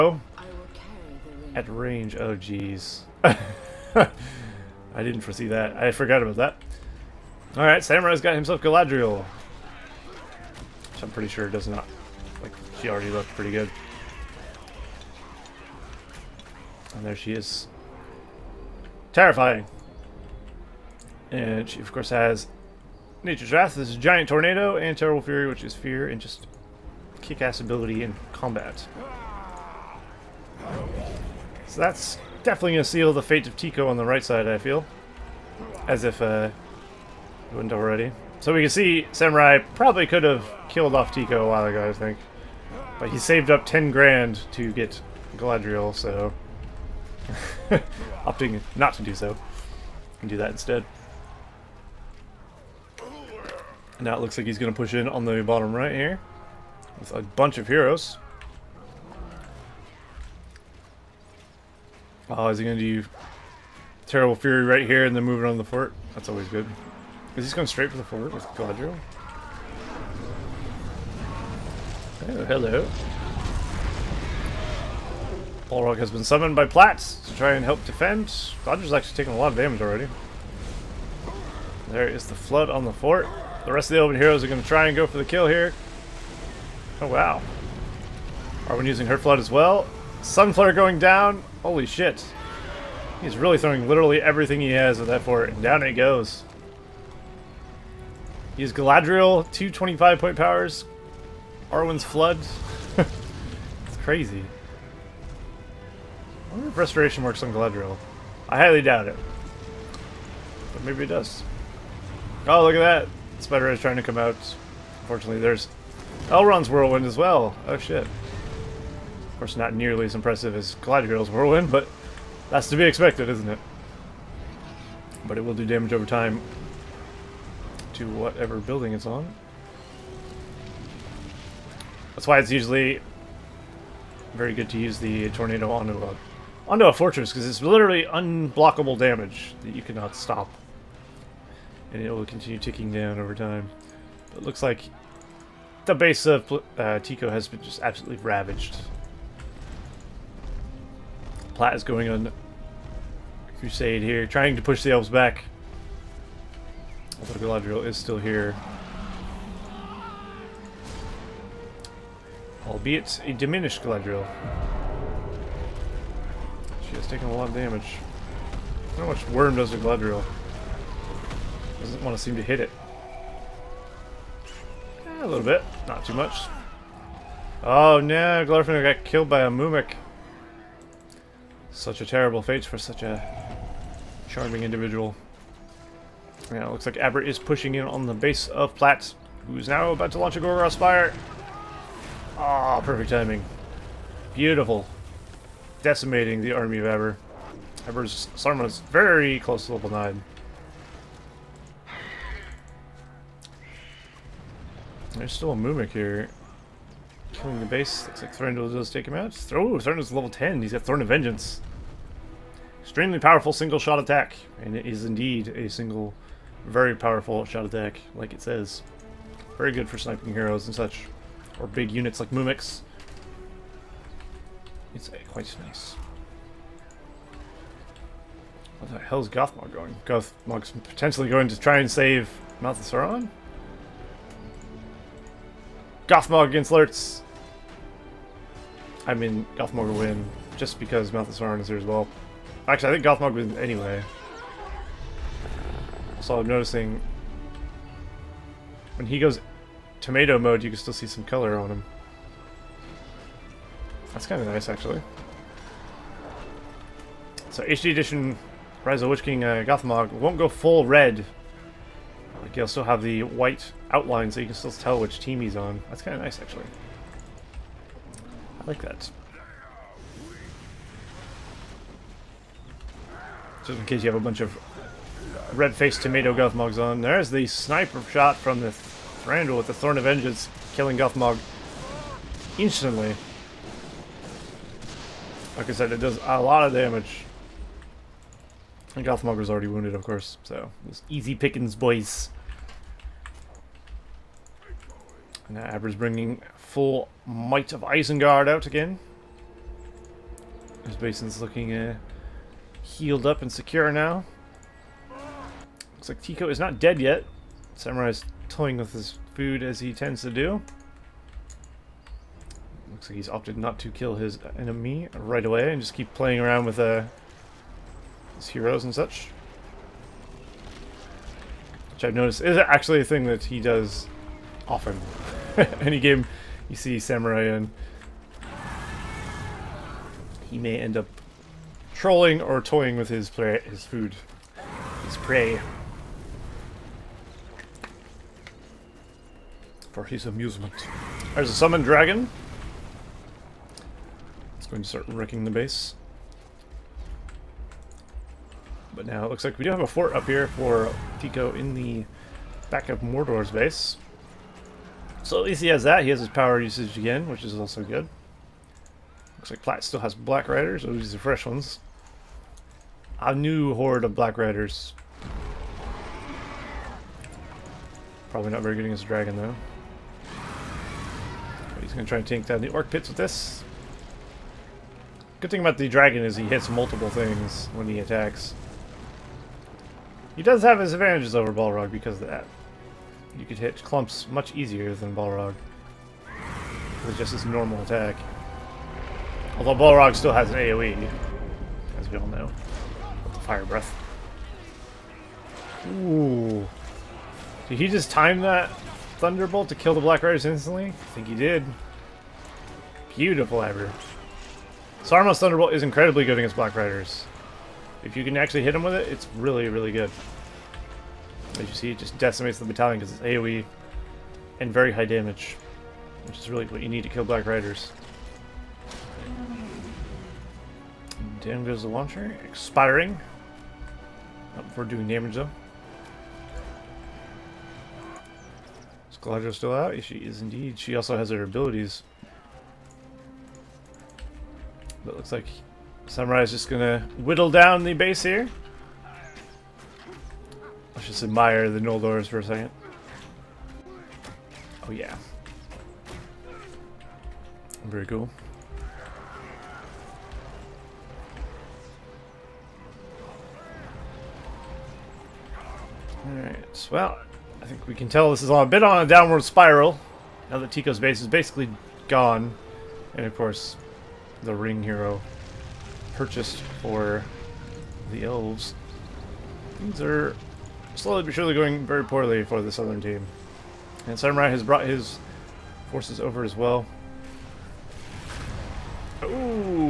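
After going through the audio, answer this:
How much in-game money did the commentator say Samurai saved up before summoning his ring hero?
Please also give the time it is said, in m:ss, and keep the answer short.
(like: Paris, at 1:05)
10 grand, at 0:43.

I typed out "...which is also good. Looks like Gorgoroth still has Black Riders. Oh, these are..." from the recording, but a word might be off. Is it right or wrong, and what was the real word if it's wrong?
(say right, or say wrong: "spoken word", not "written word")
wrong: "Plat", not "Gorgoroth".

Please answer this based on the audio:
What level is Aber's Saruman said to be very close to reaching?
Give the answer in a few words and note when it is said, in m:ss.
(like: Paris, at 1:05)
level 9, at 3:19.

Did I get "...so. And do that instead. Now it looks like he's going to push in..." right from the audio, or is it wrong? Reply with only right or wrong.
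right.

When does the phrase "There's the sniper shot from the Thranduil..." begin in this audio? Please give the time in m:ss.
4:36.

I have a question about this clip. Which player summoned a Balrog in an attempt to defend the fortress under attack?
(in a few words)
Platts.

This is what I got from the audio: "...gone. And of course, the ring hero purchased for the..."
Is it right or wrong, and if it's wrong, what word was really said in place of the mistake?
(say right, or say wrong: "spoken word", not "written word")
right.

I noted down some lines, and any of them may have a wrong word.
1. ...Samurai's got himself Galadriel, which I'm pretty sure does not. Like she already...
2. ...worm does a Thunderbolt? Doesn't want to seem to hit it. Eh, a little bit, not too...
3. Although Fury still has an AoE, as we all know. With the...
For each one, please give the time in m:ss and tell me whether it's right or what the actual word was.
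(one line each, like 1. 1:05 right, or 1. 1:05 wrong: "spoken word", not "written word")
1. 0:07 right
2. 2:49 wrong: "Galadriel", not "Thunderbolt"
3. 6:29 wrong: "Balrog", not "Fury".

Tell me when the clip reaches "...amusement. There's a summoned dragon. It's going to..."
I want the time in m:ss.
5:40.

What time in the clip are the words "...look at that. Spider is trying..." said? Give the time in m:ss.
1:52.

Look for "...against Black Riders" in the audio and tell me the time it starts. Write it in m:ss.
6:46.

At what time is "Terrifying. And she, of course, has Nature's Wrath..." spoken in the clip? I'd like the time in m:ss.
0:19.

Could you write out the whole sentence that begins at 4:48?
And Gothmog was already wounded, of course, so it's easy pickings, boys.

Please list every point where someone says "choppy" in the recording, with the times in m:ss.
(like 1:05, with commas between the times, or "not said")
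not said.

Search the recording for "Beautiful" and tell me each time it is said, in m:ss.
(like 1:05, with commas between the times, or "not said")
3:14, 6:43.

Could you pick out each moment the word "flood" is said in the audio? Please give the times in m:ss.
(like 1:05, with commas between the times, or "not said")
1:22, 1:29, 1:42.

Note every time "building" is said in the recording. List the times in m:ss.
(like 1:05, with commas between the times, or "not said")
2:08.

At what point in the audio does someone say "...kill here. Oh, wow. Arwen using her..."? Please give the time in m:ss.
1:25.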